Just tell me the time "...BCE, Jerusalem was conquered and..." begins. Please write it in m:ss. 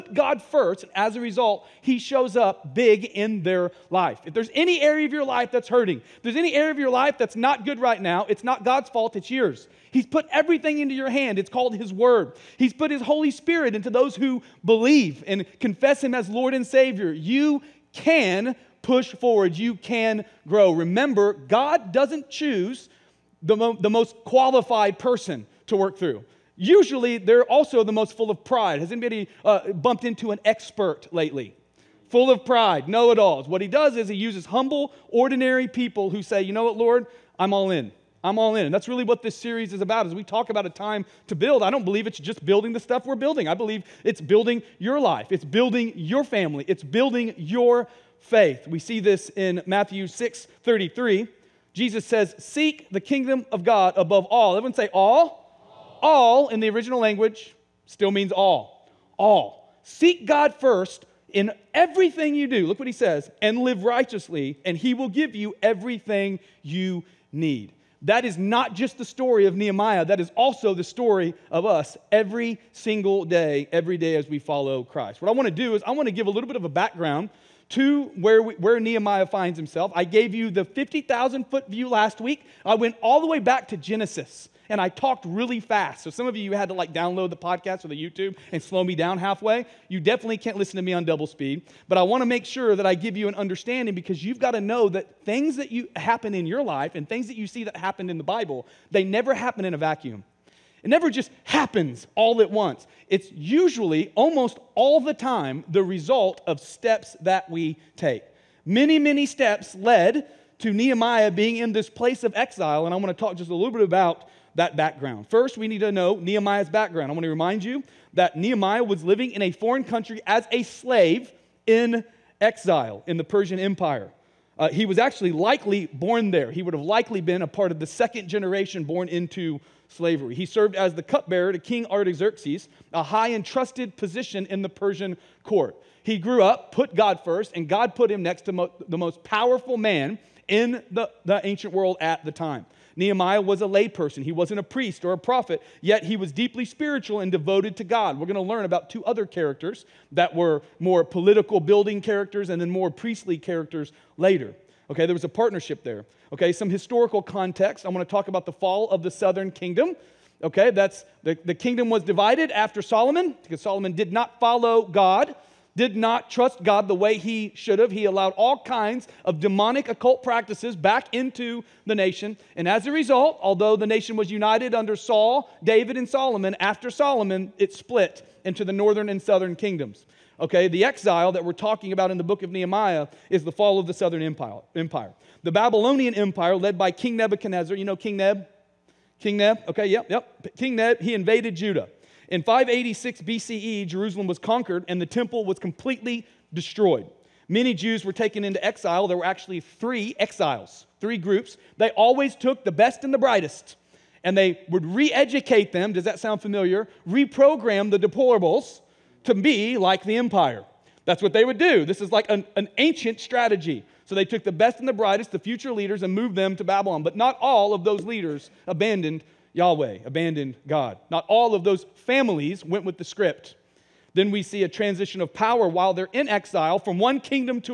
3:13.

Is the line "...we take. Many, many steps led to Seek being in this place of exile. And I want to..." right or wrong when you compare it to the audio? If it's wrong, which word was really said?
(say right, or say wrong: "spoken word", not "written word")
wrong: "Nehemiah", not "Seek".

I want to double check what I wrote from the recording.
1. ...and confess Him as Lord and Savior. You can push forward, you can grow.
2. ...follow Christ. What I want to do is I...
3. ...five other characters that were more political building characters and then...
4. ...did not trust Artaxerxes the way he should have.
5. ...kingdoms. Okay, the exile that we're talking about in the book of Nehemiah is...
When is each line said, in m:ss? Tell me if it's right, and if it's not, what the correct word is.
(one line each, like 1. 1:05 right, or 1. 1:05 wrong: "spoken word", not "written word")
1. 0:15 right
2. 1:14 right
3. 2:28 wrong: "two", not "five"
4. 2:45 wrong: "God", not "Artaxerxes"
5. 2:59 right.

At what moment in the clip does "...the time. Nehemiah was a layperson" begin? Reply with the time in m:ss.
2:22.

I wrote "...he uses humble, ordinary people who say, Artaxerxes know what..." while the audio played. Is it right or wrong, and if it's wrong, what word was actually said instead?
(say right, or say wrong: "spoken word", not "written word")
wrong: "You", not "Artaxerxes".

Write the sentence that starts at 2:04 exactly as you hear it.
Uh, he was actually likely born there.